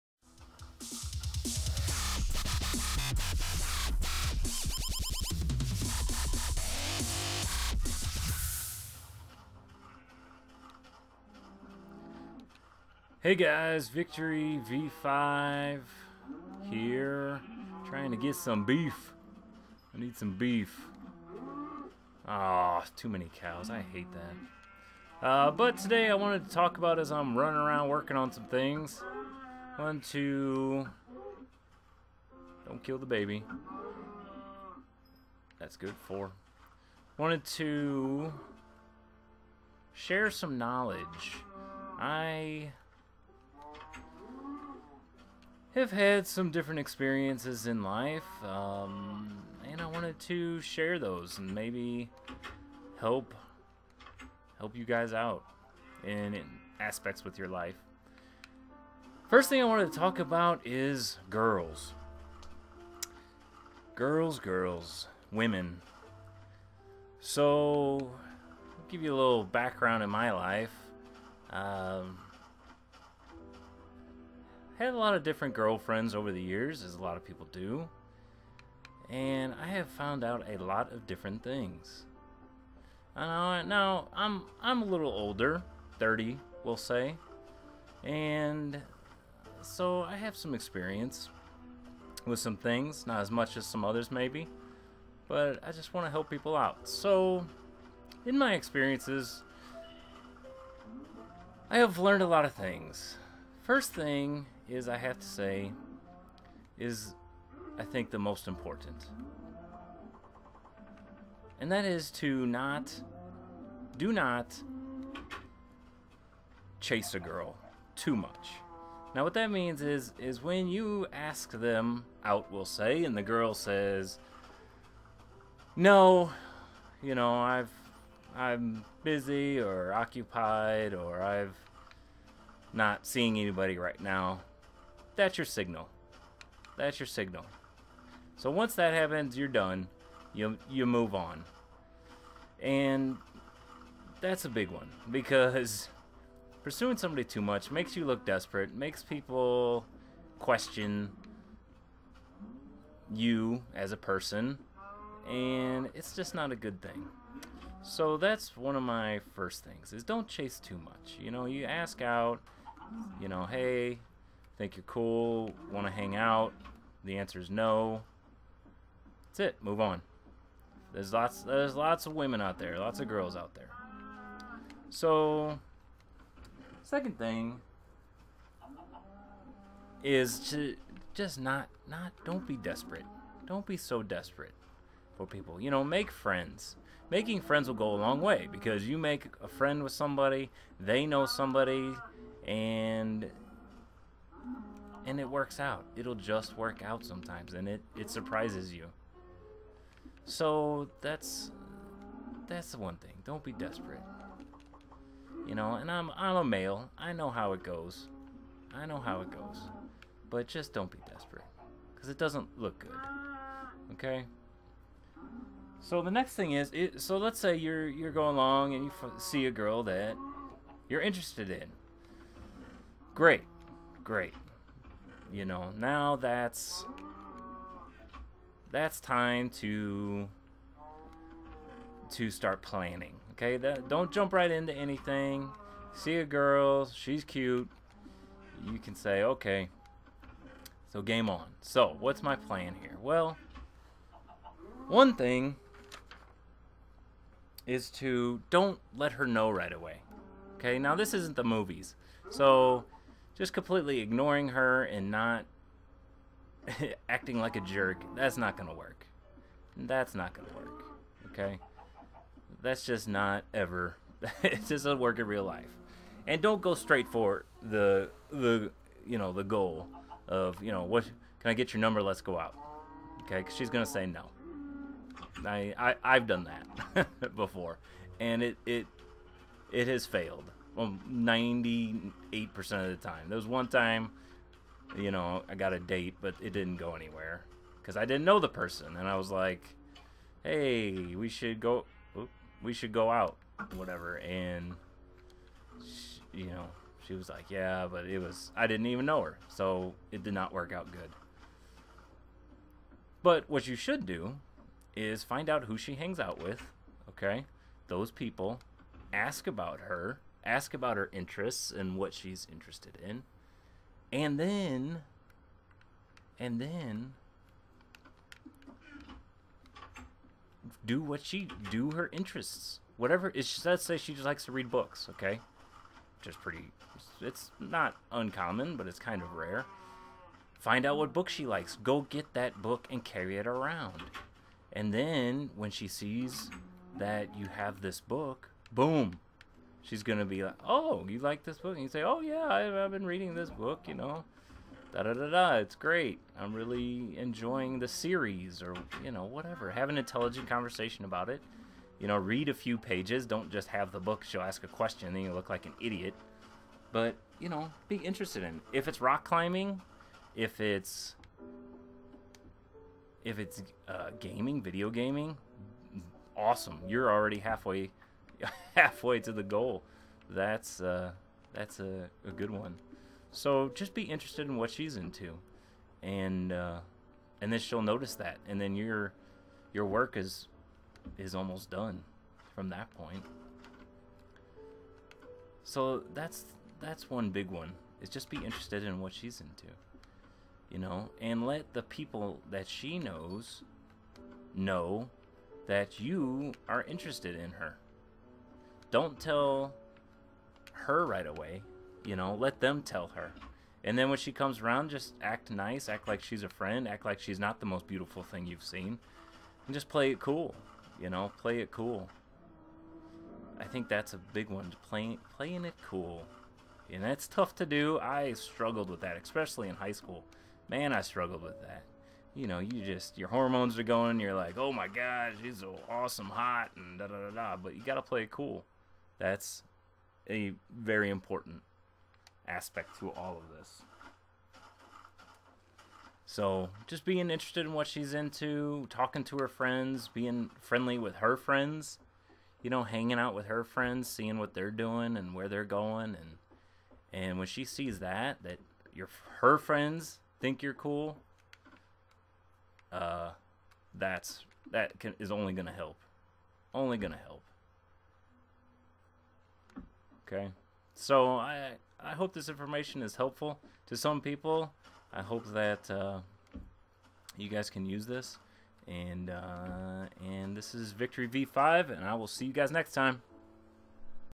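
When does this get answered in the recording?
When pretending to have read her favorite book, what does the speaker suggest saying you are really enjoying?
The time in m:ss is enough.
5:47.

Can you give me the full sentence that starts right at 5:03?
But what you should do is find out who she hangs out with, okay?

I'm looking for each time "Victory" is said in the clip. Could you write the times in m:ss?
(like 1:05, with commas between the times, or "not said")
0:13, 7:50.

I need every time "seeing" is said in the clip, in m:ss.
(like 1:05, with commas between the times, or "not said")
2:13, 7:24.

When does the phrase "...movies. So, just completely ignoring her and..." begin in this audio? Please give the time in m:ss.
4:11.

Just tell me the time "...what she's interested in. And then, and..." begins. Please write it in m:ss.
5:11.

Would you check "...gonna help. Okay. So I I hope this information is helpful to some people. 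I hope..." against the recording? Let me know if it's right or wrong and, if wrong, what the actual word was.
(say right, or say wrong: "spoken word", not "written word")
right.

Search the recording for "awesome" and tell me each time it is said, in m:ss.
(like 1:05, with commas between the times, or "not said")
6:06, 7:05.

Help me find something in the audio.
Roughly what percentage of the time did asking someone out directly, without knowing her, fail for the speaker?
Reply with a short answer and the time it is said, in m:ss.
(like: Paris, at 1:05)
98%, at 4:41.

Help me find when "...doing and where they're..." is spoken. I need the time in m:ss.
7:24.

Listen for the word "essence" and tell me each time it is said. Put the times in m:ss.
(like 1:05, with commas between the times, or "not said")
not said.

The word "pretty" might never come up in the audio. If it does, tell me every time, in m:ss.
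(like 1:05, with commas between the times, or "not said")
5:26.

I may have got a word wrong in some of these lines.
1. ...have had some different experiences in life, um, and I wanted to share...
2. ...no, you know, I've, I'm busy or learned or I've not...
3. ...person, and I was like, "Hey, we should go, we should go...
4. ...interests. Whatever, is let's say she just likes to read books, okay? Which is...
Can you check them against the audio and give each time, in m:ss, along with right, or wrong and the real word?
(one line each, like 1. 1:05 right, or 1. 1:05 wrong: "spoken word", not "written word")
1. 0:45 right
2. 2:05 wrong: "occupied", not "learned"
3. 4:48 right
4. 5:22 right.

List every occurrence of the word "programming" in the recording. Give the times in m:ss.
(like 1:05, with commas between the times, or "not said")
not said.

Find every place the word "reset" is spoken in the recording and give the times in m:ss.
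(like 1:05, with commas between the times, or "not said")
not said.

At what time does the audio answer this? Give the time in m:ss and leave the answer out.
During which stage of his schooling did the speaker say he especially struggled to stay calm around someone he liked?
6:59.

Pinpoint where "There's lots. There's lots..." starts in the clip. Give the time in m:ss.
2:50.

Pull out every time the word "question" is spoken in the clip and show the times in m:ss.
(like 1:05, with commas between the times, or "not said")
2:30, 5:54.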